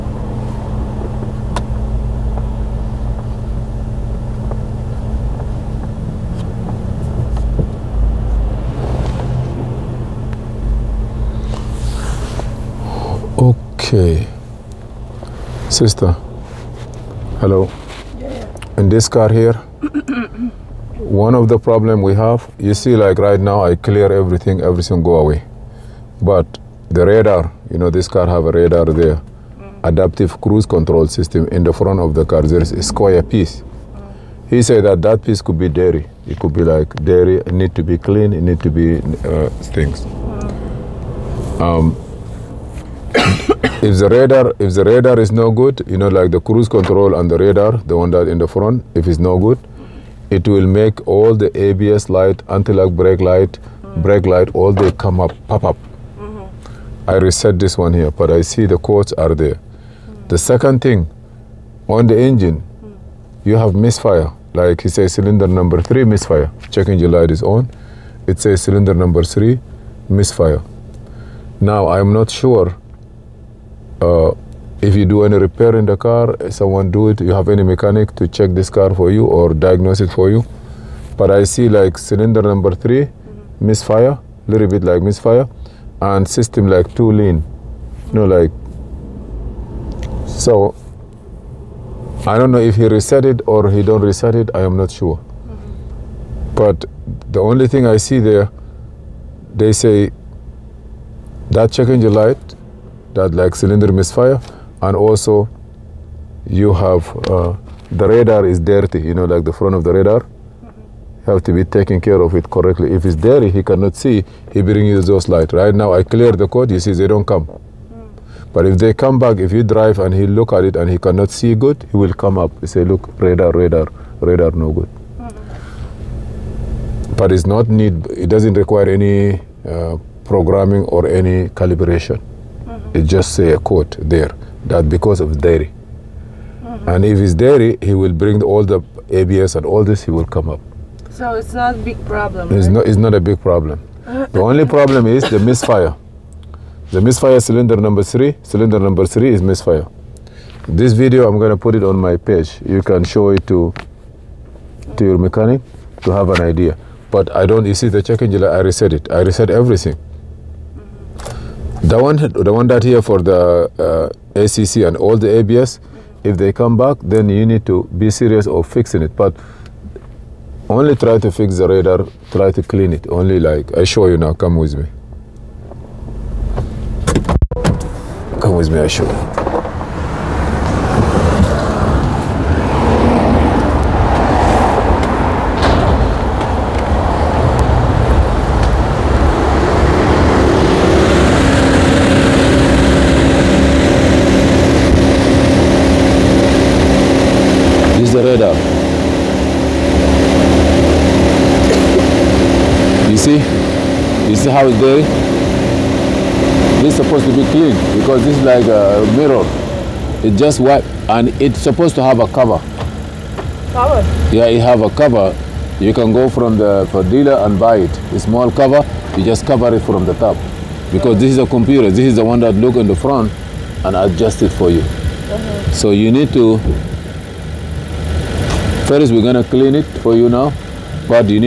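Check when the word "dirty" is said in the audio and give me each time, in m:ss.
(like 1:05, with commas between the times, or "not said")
1:48, 1:53.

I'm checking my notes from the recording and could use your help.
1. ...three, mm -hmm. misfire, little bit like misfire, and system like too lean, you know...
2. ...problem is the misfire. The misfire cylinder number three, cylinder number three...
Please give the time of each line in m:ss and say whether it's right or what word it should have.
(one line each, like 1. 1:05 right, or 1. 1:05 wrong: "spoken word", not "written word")
1. 1:22 right
2. 2:24 right.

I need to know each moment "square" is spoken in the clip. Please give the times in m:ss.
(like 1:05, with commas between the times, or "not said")
0:32.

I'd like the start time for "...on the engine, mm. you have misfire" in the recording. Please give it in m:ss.
1:01.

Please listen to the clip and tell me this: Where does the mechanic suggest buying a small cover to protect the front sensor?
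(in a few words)
dealer.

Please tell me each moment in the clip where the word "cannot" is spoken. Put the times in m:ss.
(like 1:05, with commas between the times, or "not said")
1:53, 2:01.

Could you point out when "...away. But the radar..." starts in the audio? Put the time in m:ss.
0:25.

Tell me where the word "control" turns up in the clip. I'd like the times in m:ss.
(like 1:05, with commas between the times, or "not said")
0:30, 0:46.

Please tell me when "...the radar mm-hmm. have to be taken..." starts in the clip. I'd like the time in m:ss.
1:49.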